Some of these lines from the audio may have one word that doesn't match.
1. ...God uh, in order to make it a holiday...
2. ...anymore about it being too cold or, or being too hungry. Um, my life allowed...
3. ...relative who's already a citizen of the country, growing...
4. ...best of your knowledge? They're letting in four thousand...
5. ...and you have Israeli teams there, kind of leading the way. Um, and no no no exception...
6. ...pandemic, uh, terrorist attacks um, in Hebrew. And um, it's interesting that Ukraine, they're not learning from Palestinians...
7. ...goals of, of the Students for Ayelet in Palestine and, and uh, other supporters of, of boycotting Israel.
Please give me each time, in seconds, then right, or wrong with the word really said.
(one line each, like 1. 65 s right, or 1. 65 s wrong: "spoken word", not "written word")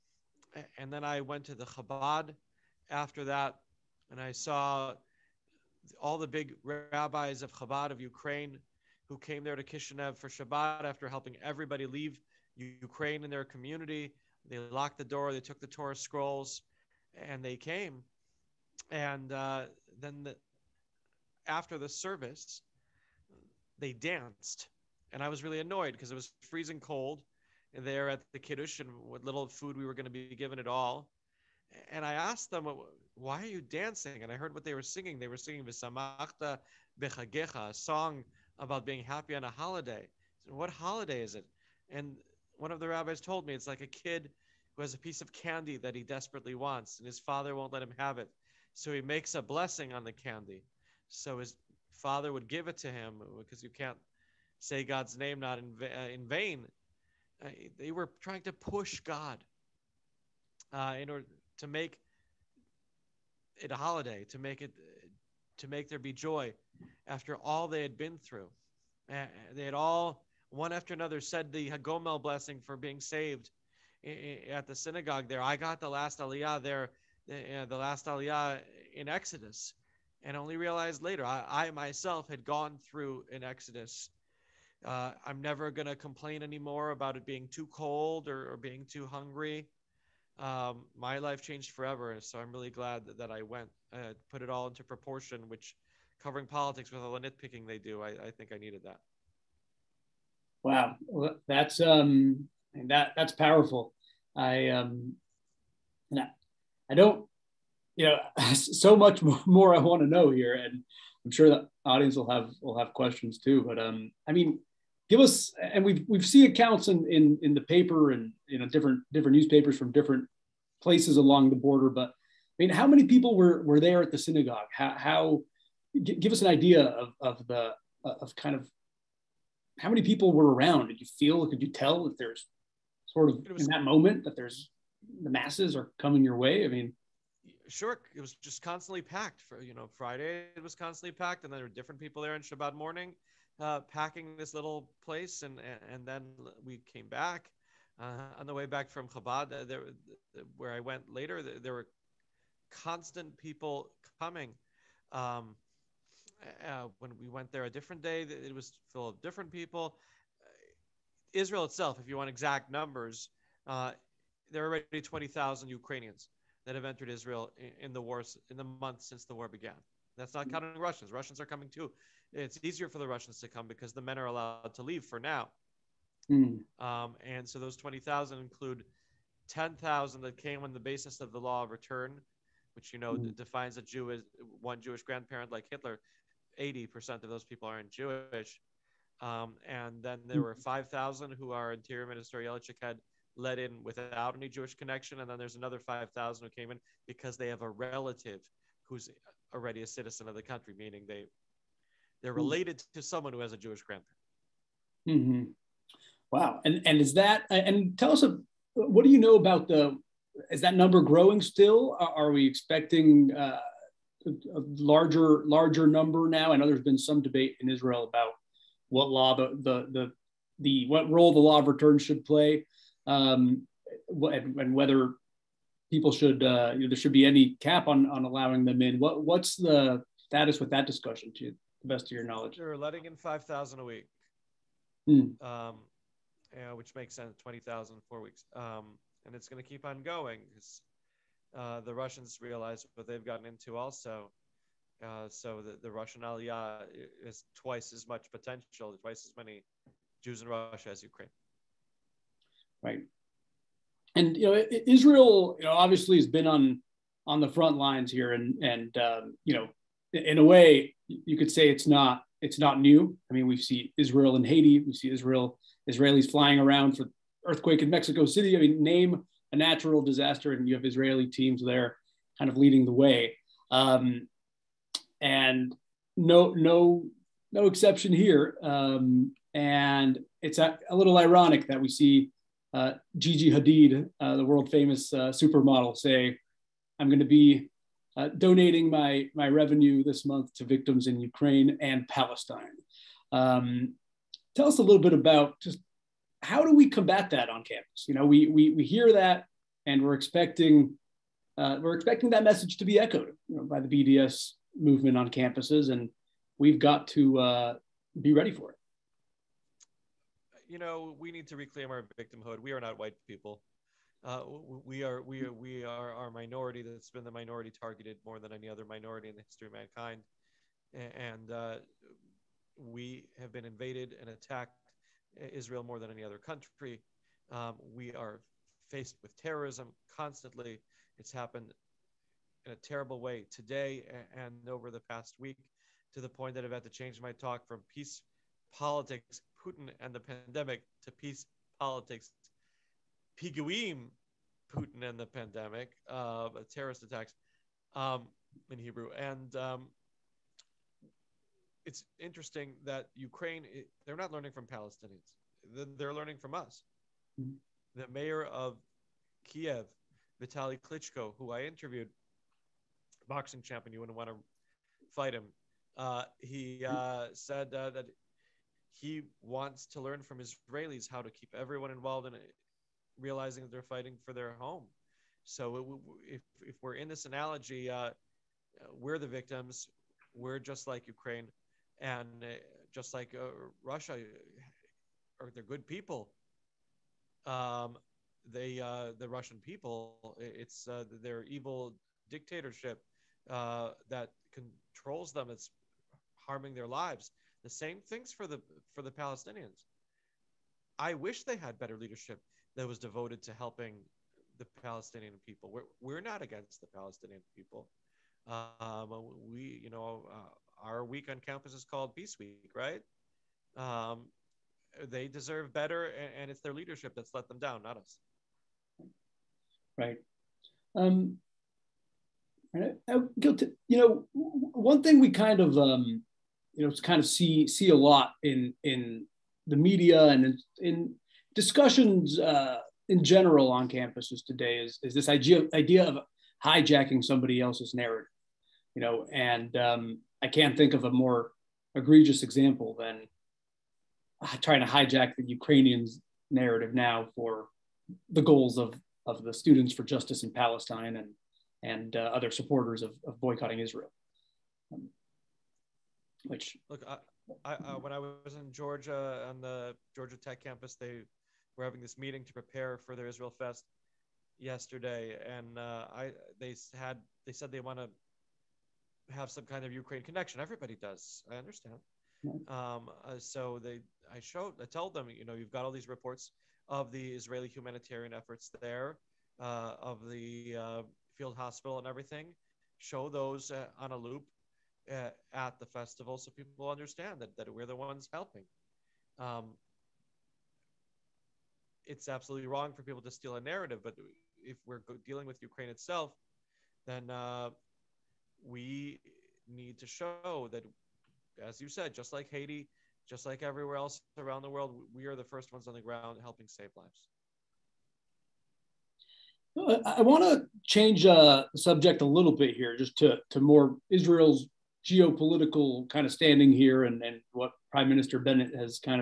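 1. 59 s right
2. 86 s wrong: "changed", not "allowed"
3. 197 s wrong: "meaning", not "growing"
4. 231 s wrong: "five", not "four"
5. 270 s right
6. 345 s right
7. 448 s wrong: "Justice", not "Ayelet".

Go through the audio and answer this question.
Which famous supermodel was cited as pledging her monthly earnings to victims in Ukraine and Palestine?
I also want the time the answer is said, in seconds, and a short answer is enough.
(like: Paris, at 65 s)
Gigi Hadid, at 283 s.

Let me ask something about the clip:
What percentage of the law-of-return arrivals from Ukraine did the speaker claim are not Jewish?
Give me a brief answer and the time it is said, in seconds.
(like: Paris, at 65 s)
80%, at 186 s.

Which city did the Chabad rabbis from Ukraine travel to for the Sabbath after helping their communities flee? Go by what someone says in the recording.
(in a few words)
Kishinev.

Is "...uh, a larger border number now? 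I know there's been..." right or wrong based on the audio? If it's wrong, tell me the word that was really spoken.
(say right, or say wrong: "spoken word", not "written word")
wrong: "larger", not "border".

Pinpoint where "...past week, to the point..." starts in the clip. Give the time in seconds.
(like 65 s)
334 s.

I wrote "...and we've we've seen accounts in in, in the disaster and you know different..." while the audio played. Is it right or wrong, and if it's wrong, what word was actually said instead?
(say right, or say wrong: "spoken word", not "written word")
wrong: "paper", not "disaster".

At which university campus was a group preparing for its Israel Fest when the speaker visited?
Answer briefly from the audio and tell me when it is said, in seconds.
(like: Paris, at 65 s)
Georgia Tech, at 460 s.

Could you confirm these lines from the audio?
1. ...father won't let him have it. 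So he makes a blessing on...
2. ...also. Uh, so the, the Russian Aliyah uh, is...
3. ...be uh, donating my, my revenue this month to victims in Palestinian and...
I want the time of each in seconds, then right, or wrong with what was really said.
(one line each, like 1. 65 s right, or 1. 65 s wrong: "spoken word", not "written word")
1. 47 s right
2. 243 s right
3. 287 s wrong: "Ukraine", not "Palestinian".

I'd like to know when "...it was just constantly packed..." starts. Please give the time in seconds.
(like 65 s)
138 s.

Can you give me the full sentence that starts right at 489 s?
Um, it's absolutely wrong for people to steal a narrative.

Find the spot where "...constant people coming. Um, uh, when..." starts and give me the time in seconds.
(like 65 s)
152 s.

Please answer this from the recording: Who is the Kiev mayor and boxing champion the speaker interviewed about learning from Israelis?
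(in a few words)
Vitaly Klitschko.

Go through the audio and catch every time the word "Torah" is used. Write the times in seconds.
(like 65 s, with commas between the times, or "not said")
15 s.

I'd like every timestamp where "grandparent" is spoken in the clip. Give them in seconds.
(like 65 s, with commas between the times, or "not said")
185 s, 203 s.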